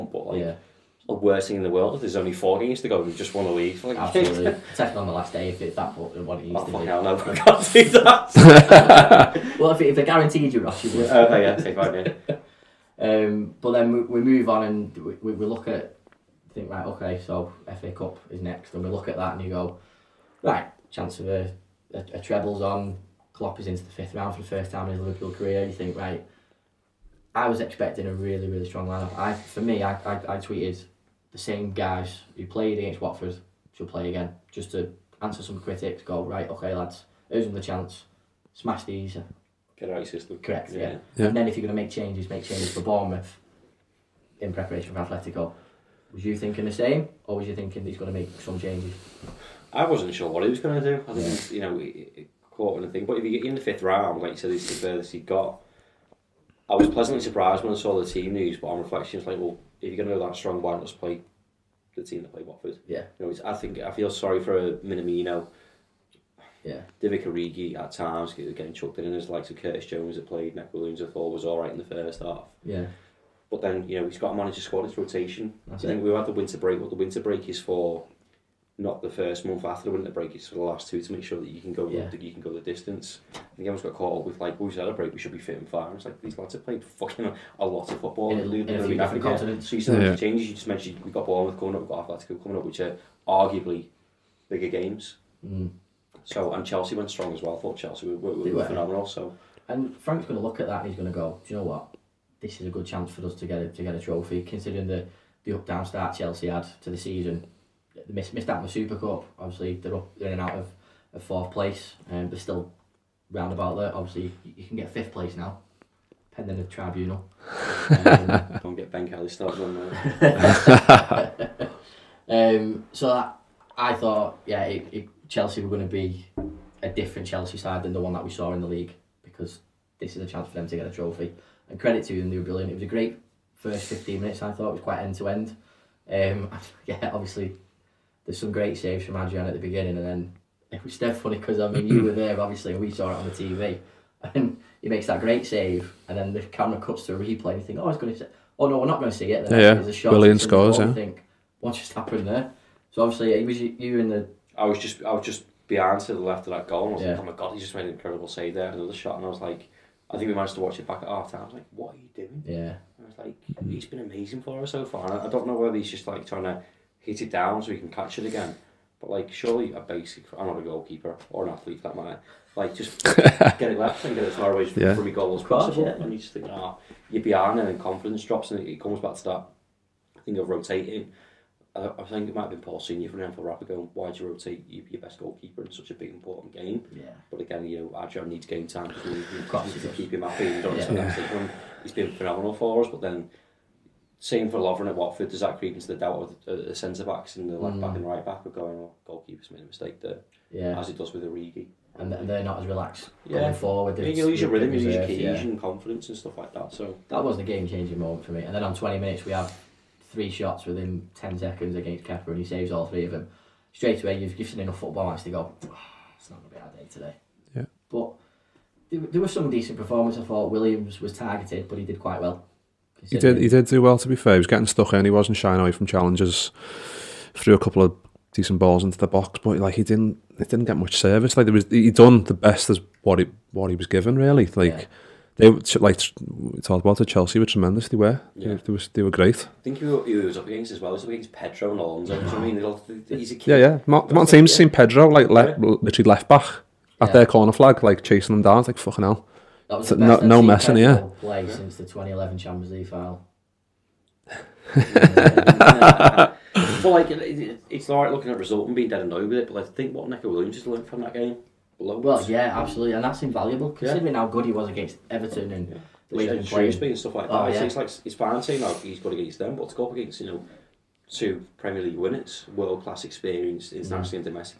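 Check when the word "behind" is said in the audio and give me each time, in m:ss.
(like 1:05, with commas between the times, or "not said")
2:35, 2:57.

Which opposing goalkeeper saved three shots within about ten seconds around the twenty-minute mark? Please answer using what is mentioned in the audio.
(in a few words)
Kepa.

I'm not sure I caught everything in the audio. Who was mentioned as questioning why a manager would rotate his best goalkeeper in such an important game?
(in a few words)
Paul Senior.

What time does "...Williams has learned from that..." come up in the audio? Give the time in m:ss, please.
4:20.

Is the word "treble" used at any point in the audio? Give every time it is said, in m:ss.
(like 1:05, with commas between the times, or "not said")
0:22.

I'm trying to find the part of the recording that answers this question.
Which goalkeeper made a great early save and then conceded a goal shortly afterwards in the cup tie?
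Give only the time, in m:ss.
2:19.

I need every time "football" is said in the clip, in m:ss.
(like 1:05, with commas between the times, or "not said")
1:28, 3:34.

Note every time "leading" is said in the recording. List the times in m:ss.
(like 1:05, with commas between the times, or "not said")
4:26.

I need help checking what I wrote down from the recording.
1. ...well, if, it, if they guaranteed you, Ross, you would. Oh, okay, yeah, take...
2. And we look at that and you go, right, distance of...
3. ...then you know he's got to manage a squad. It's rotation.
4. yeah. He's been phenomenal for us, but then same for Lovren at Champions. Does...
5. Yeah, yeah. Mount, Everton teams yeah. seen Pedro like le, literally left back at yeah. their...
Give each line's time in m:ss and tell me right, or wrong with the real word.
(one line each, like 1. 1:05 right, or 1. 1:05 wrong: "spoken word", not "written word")
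1. 0:09 right
2. 0:18 wrong: "chance", not "distance"
3. 1:13 right
4. 3:10 wrong: "Watford", not "Champions"
5. 4:03 wrong: "Mount", not "Everton".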